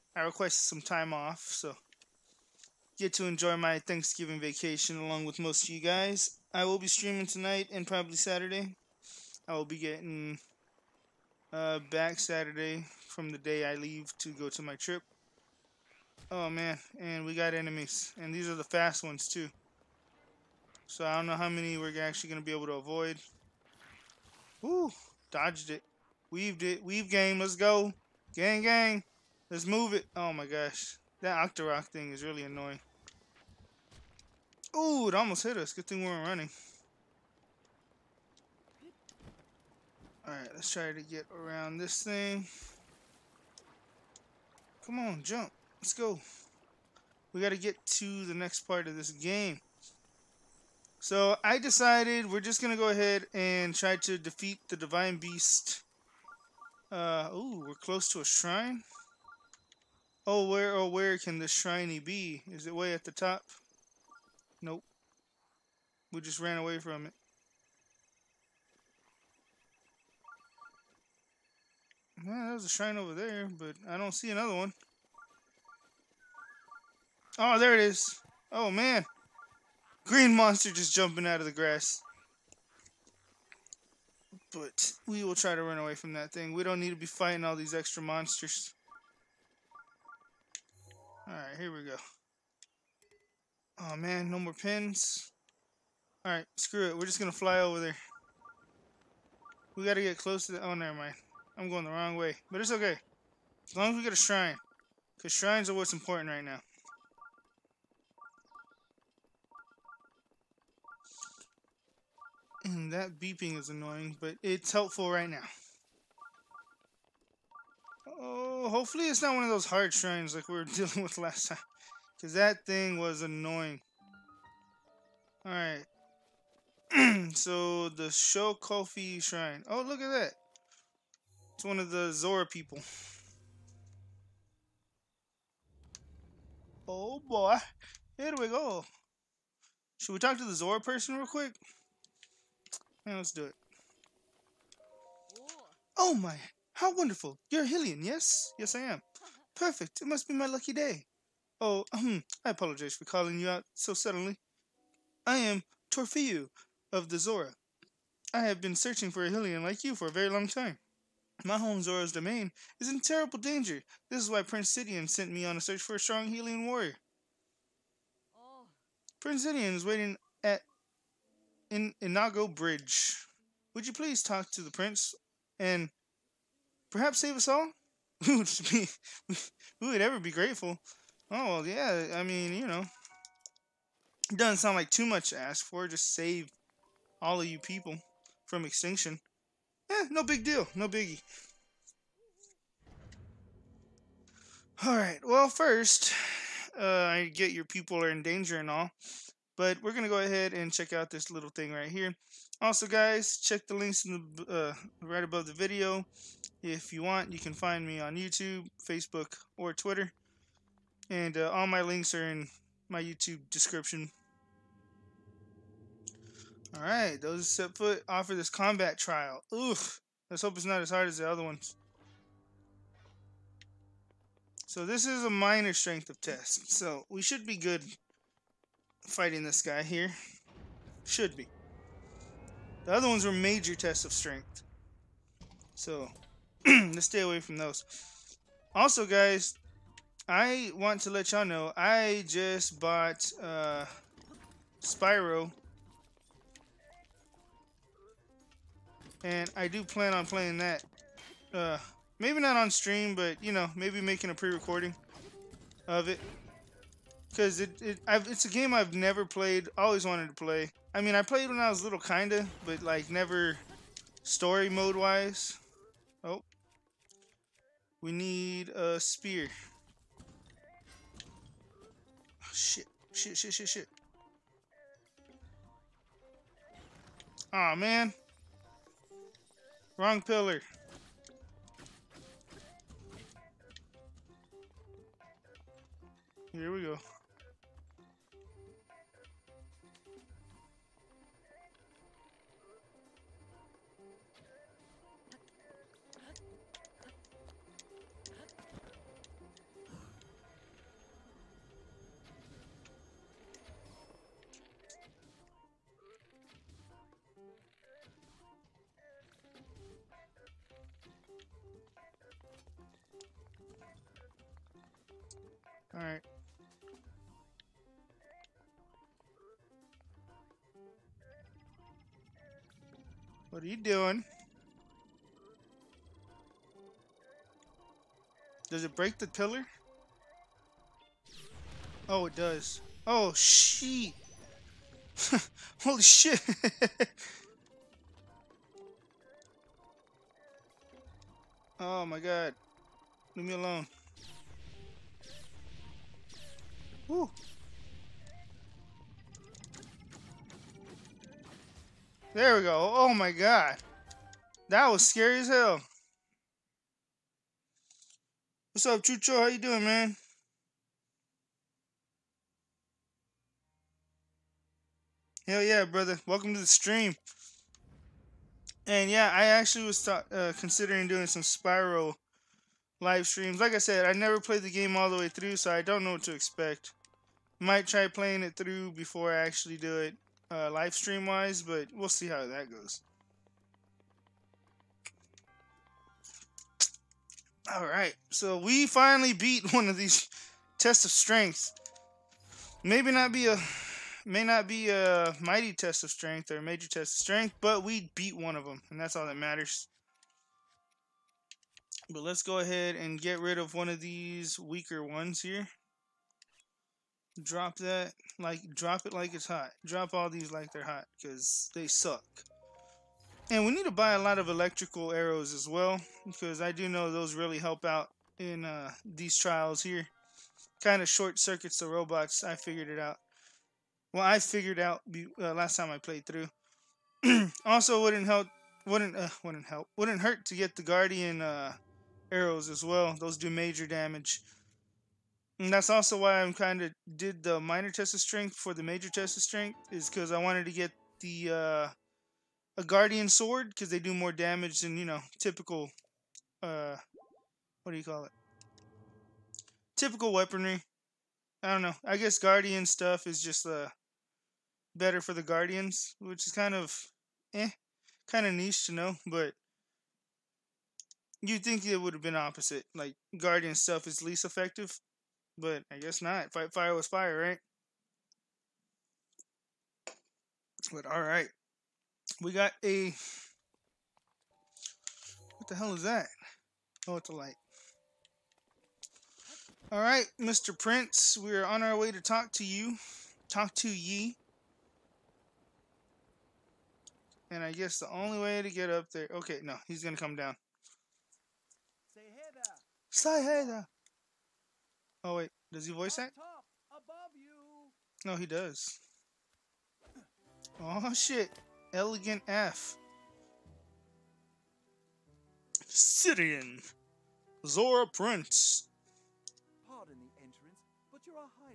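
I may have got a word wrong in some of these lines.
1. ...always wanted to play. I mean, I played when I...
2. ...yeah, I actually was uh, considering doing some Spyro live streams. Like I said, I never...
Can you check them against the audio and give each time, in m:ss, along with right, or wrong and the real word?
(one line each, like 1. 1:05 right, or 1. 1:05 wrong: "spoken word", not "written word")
1. 4:19 right
2. 6:09 right.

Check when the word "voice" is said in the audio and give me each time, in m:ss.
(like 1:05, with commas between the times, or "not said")
8:15.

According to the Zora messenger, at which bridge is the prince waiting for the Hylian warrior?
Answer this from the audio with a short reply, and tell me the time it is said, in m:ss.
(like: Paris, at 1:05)
Inago Bridge, at 2:52.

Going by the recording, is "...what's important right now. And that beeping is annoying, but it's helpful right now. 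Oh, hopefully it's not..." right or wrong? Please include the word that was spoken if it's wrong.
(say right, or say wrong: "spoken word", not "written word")
right.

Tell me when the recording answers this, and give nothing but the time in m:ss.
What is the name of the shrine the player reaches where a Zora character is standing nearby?
2:08.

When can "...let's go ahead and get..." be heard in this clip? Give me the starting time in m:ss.
6:42.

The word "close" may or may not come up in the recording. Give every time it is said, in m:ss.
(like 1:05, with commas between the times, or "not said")
0:57, 1:40.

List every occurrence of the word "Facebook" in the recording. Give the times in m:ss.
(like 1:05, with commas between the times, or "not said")
3:28.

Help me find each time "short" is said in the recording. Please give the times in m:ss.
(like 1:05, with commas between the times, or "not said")
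7:01.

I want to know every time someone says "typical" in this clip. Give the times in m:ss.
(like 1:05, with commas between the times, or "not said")
7:25, 7:29.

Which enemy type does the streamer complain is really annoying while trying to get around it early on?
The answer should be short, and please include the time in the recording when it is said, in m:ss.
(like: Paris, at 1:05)
Octorok, at 0:31.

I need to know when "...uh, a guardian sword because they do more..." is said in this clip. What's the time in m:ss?
7:21.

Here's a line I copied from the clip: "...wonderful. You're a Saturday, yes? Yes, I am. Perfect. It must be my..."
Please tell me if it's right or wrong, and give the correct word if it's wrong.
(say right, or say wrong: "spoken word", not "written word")
wrong: "Hillian", not "Saturday".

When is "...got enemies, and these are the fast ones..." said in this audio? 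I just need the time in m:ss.
0:17.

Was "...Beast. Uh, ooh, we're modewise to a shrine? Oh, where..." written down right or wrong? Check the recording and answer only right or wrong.
wrong.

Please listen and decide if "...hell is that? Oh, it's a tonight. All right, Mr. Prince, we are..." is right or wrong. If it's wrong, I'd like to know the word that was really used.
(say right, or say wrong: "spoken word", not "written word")
wrong: "light", not "tonight".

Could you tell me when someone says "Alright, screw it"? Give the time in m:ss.
1:36.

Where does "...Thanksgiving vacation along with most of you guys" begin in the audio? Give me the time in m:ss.
0:03.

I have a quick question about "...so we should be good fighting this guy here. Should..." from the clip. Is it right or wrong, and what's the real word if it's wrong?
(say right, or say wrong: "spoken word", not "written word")
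right.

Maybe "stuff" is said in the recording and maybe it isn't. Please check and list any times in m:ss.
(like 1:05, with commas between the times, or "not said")
7:32, 7:43.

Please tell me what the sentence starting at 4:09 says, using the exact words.
And I do plan on playing that.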